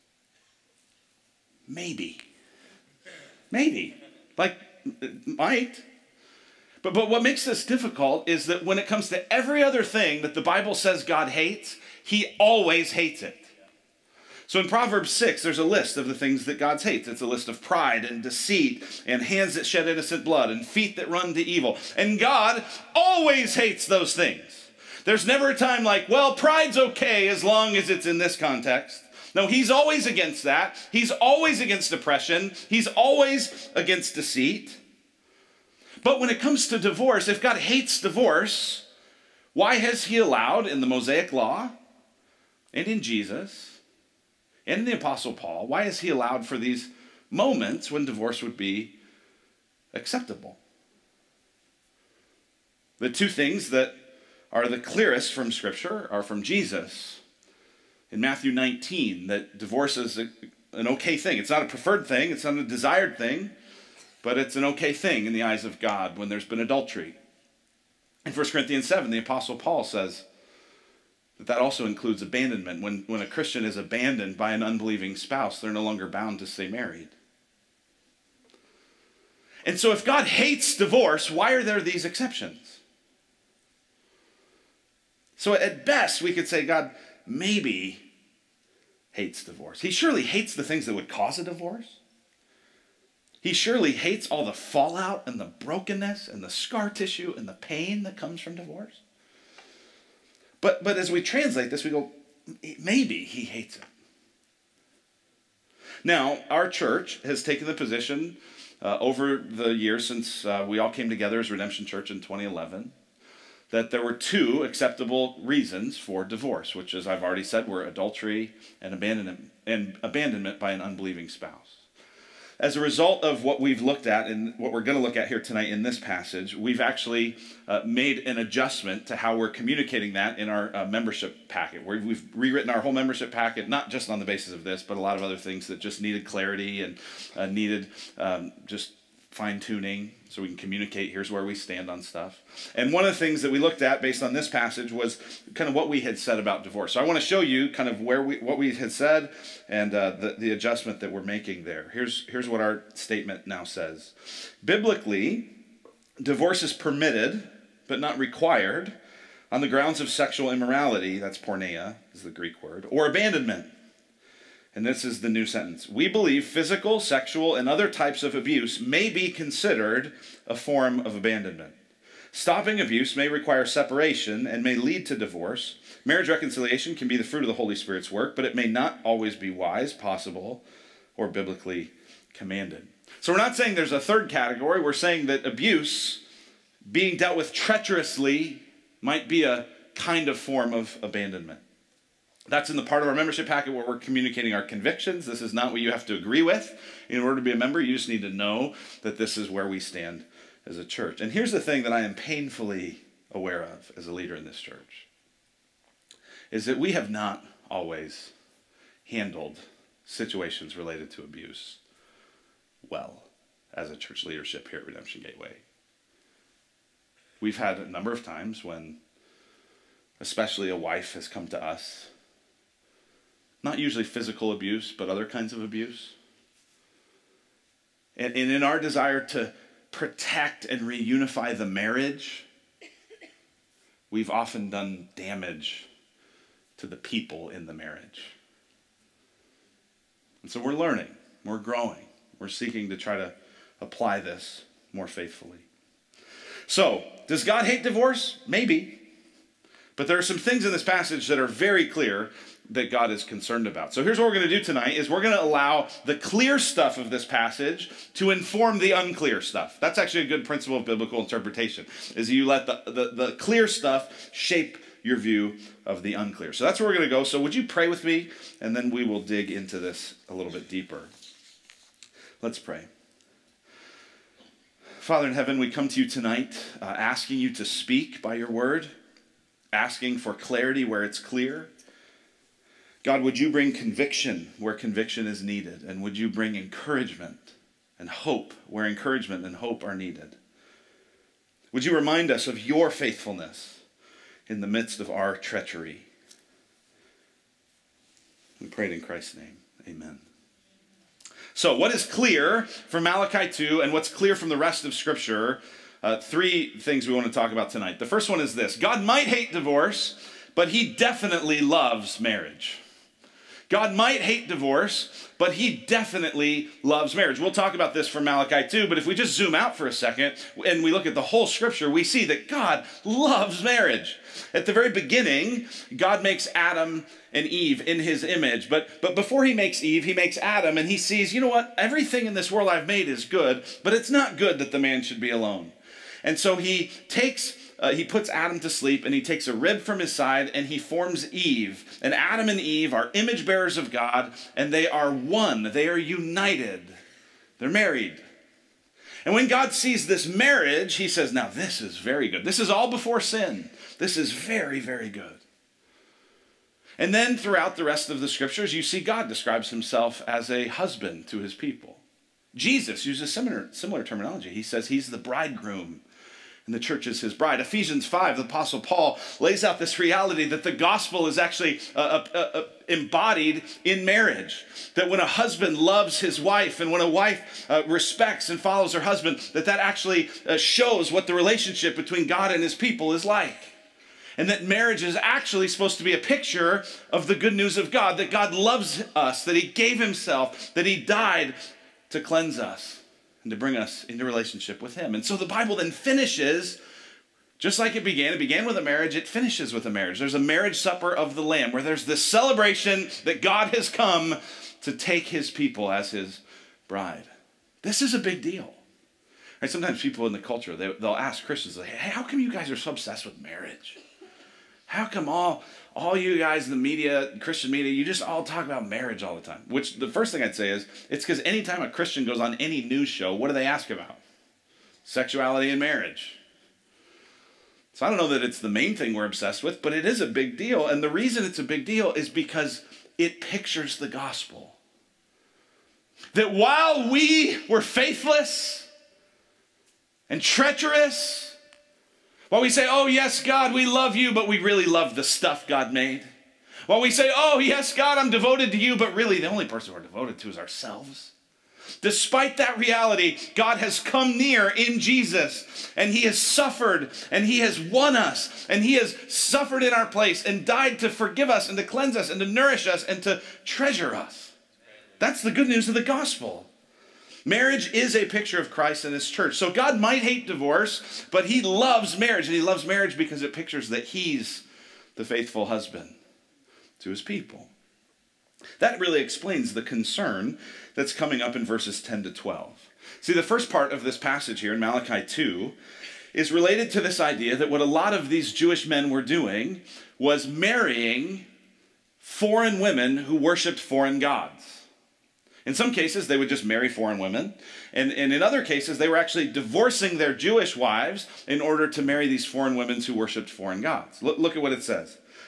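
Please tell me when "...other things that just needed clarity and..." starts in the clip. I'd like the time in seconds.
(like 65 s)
135 s.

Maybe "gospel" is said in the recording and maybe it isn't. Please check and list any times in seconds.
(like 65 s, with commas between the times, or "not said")
370 s, 434 s, 466 s.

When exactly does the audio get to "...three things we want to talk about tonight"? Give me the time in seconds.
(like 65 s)
306 s.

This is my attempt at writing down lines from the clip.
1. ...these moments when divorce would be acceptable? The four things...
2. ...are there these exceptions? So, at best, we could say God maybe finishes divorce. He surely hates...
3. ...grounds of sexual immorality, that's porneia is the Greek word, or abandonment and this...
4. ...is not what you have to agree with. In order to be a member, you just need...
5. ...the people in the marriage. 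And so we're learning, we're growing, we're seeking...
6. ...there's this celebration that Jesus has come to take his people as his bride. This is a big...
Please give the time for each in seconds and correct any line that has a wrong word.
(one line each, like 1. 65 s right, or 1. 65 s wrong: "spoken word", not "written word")
1. 46 s wrong: "two", not "four"
2. 81 s wrong: "hates", not "finishes"
3. 159 s right
4. 195 s right
5. 236 s right
6. 401 s wrong: "God", not "Jesus".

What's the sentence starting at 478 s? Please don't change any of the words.
That really explains the concern that's coming up in verses 10 to 12.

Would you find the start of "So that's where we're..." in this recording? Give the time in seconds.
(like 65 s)
266 s.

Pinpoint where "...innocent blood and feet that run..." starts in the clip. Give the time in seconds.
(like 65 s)
19 s.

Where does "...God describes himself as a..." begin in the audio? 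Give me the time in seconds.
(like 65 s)
359 s.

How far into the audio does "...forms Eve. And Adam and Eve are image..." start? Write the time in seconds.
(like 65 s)
340 s.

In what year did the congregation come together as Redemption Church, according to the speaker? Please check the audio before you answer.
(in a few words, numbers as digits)
2011.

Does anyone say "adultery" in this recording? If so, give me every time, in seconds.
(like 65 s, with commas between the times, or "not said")
66 s, 117 s.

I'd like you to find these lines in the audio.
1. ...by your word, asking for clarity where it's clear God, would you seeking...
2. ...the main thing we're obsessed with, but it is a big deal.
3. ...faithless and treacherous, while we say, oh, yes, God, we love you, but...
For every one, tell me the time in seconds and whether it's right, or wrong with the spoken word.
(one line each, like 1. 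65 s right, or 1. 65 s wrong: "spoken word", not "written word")
1. 278 s wrong: "bring", not "seeking"
2. 428 s right
3. 437 s right.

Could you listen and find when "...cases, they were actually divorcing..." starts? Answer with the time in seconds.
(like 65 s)
498 s.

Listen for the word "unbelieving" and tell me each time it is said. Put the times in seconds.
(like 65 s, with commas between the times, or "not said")
74 s, 120 s.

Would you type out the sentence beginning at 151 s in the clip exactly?
Here's here's what our statement now says.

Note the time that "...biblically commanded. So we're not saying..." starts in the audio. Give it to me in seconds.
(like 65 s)
181 s.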